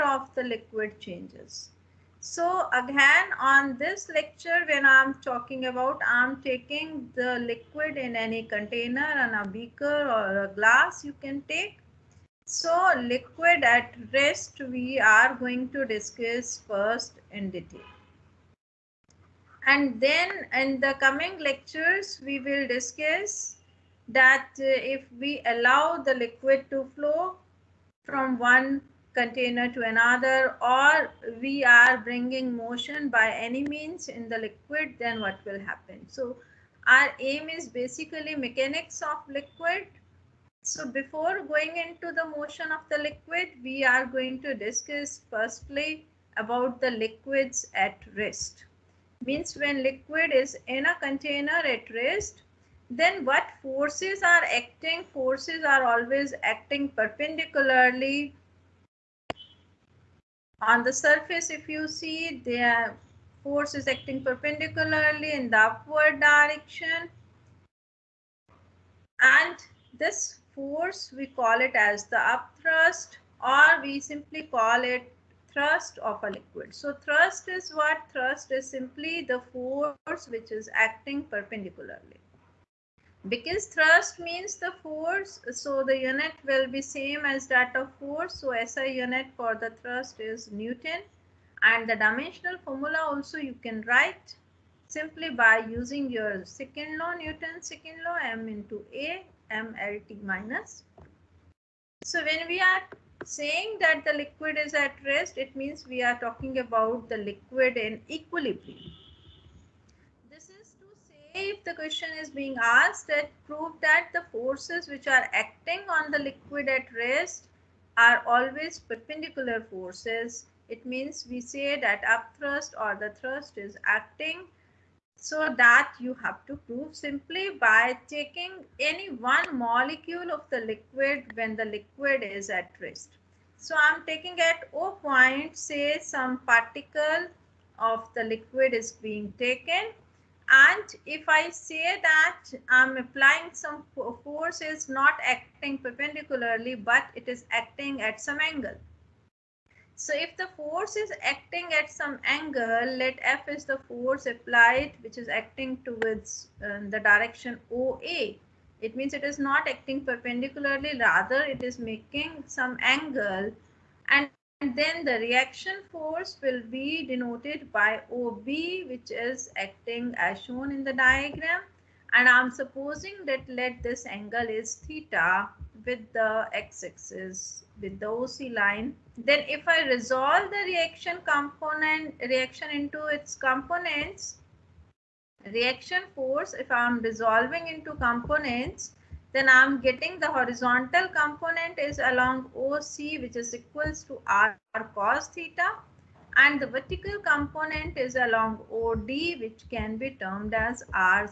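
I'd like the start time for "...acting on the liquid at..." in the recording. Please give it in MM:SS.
01:55.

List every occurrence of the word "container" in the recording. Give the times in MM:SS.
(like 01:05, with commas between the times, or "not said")
00:08, 00:29, 00:51.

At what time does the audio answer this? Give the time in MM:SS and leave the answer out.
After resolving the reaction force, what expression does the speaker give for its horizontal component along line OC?
03:14.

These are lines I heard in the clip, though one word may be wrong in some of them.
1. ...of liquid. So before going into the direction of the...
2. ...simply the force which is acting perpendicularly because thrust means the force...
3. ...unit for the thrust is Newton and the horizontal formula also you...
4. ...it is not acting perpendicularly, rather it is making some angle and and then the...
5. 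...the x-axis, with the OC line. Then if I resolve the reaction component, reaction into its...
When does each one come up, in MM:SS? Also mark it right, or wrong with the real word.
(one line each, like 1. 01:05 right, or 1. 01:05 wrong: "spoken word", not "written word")
1. 00:39 wrong: "motion", not "direction"
2. 01:18 right
3. 01:28 wrong: "dimensional", not "horizontal"
4. 02:39 right
5. 02:56 right.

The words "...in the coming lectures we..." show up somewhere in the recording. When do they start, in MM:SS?
00:20.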